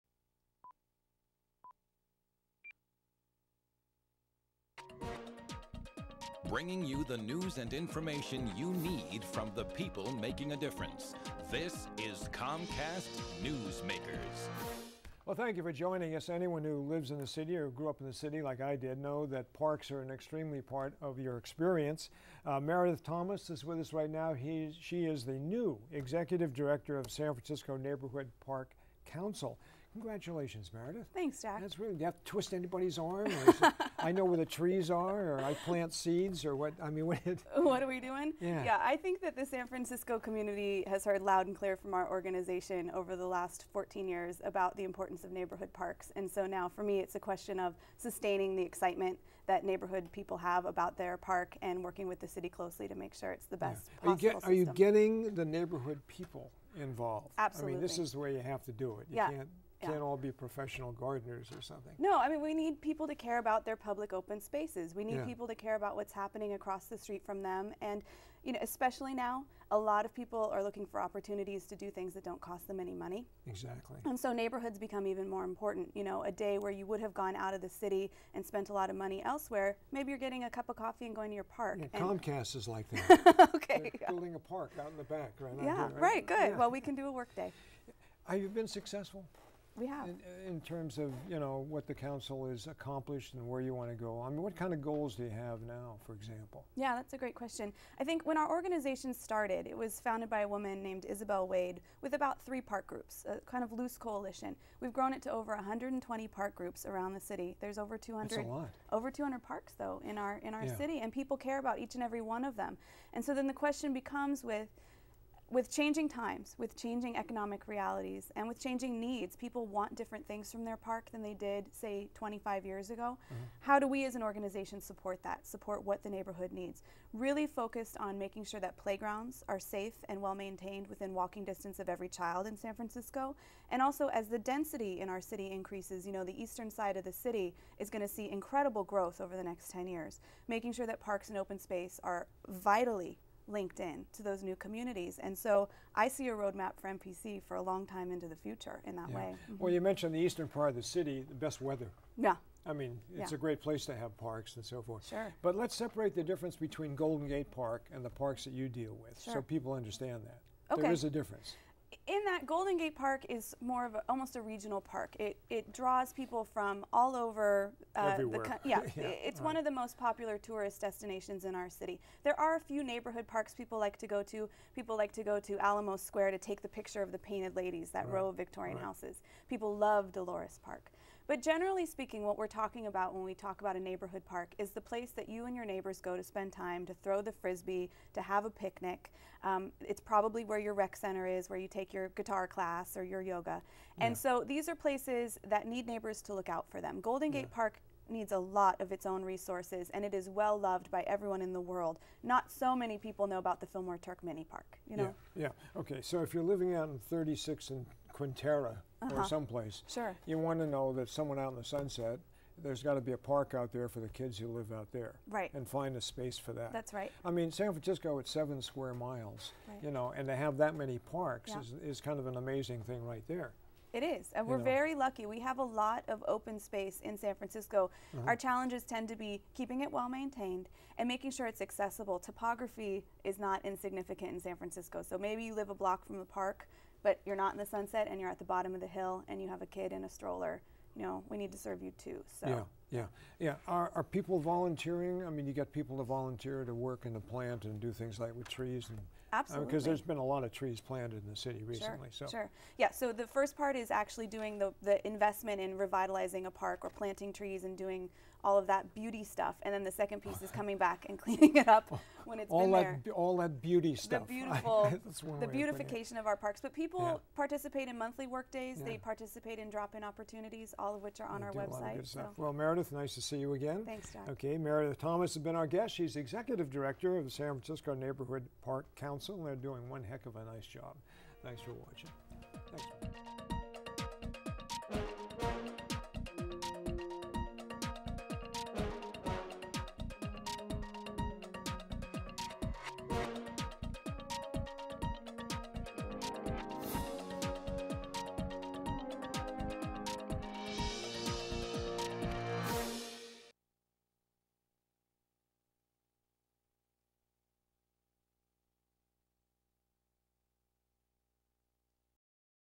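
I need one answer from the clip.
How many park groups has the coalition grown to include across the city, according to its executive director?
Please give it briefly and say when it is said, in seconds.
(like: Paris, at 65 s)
Over 120, at 105 s.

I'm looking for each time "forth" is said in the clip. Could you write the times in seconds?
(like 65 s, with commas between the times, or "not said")
154 s.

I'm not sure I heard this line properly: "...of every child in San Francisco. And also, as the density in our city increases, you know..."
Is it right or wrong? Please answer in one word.
right.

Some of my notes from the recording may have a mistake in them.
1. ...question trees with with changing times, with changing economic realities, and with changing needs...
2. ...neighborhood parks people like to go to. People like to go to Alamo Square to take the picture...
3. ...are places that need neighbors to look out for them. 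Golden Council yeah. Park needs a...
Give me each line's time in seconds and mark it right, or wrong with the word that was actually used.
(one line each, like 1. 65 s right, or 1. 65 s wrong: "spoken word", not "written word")
1. 113 s wrong: "becomes", not "trees"
2. 172 s right
3. 194 s wrong: "Gate", not "Council".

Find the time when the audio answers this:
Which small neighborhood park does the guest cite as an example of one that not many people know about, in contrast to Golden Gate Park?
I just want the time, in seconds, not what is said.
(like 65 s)
203 s.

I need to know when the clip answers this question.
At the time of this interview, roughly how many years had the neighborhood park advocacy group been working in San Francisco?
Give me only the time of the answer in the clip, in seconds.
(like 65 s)
43 s.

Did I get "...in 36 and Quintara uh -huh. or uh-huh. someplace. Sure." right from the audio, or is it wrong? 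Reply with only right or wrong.
right.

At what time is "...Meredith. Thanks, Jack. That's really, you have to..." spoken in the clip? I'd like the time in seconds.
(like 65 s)
30 s.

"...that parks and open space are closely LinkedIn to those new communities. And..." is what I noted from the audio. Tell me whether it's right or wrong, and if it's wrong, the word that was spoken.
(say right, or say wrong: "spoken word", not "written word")
wrong: "vitally", not "closely".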